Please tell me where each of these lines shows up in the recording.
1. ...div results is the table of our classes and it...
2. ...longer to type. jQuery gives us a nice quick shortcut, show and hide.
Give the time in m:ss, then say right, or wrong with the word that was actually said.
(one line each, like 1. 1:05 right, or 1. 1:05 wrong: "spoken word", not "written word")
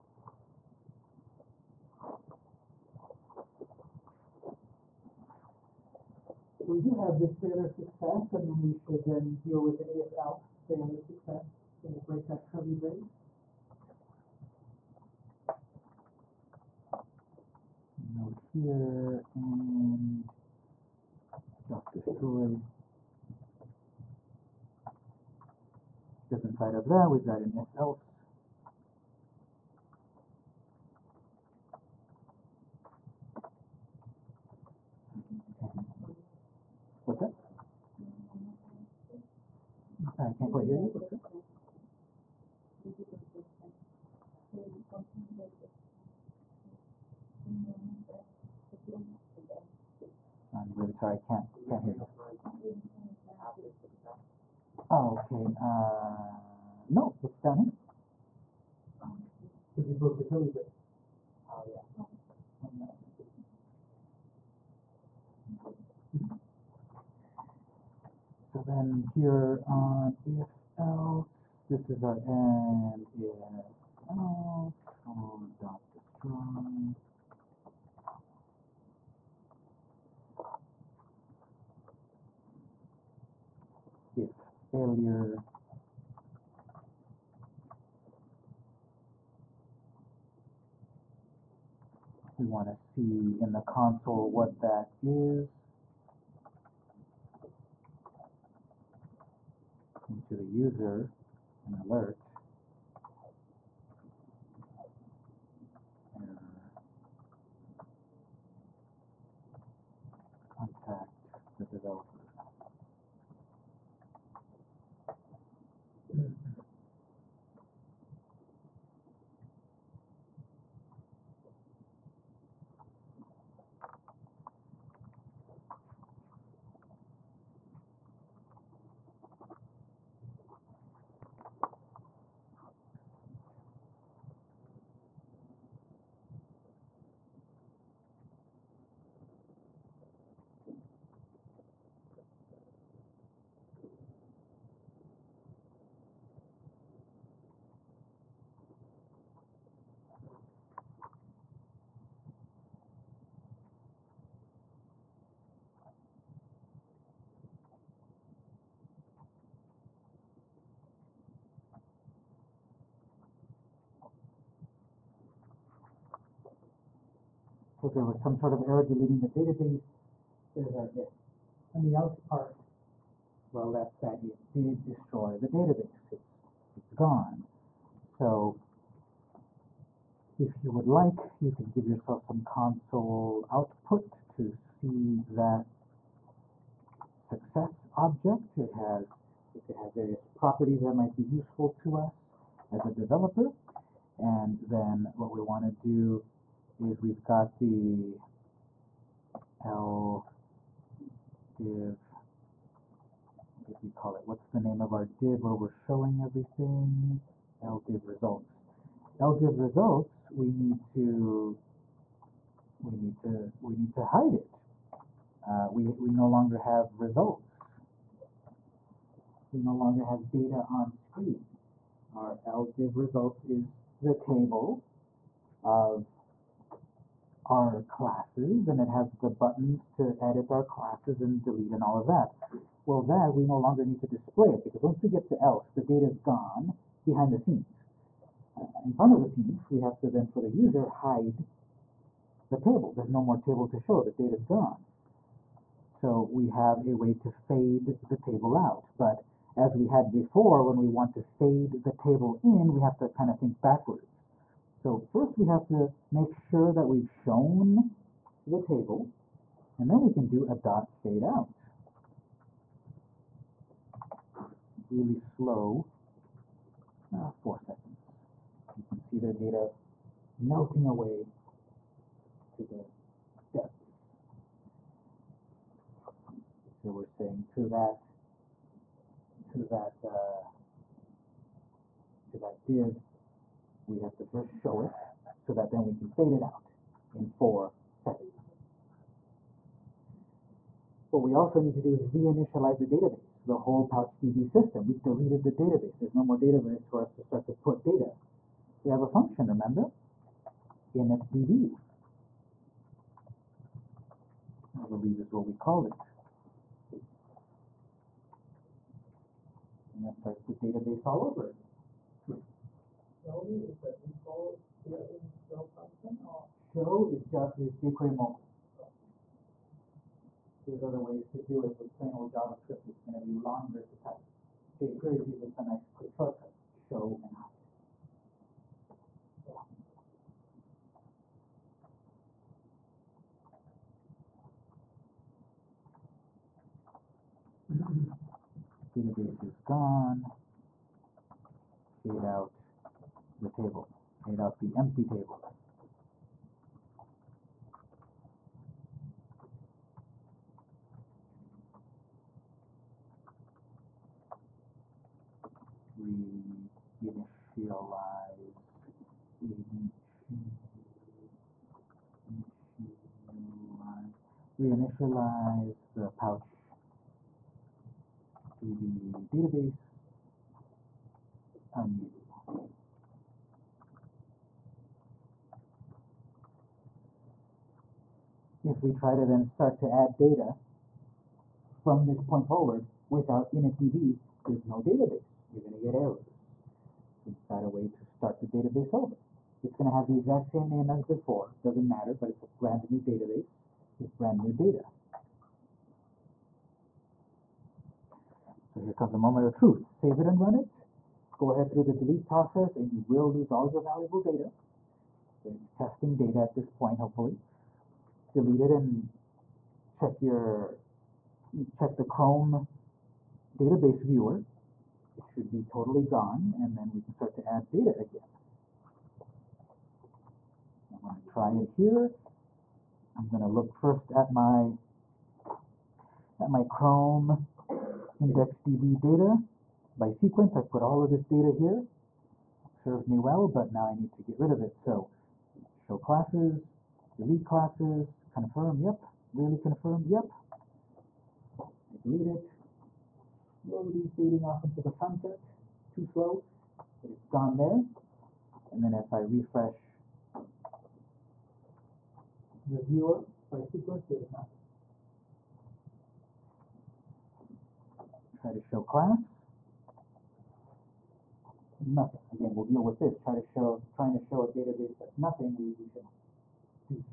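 1. 3:42 right
2. 5:23 right.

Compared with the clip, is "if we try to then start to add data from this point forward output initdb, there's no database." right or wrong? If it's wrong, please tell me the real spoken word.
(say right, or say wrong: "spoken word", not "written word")
wrong: "without", not "output".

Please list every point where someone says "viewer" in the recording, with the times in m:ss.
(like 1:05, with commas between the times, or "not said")
6:54, 7:32.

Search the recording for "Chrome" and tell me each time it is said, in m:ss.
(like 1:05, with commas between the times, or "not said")
6:52, 7:06.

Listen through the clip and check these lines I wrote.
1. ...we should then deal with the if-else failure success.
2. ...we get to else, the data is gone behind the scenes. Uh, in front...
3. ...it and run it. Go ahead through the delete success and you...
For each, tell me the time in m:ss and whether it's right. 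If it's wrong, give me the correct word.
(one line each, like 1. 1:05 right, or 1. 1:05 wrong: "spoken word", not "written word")
1. 0:08 right
2. 3:55 right
3. 6:40 wrong: "process", not "success".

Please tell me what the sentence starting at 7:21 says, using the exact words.
I delete it, slowly fading off into the sunset, too slow, but it's gone there.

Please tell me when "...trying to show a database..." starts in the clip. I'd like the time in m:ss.
7:43.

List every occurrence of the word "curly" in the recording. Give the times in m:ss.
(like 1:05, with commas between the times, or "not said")
0:12, 1:00.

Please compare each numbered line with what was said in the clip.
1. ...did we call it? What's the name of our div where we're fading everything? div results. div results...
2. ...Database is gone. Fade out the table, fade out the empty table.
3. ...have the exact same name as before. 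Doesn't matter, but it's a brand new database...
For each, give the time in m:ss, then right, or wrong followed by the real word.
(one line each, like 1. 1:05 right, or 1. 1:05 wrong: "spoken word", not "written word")
1. 3:23 wrong: "showing", not "fading"
2. 5:38 right
3. 6:29 right.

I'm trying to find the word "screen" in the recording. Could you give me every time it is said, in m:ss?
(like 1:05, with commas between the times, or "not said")
3:40.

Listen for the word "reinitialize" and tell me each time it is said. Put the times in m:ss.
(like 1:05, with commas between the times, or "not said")
4:52, 5:56, 6:04.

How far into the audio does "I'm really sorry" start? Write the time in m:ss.
0:50.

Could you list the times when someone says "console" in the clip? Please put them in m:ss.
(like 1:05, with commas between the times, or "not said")
1:33, 3:02.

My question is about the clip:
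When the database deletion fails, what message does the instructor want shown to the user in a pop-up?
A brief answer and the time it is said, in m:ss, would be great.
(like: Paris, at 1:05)
Error contact the developer, at 1:46.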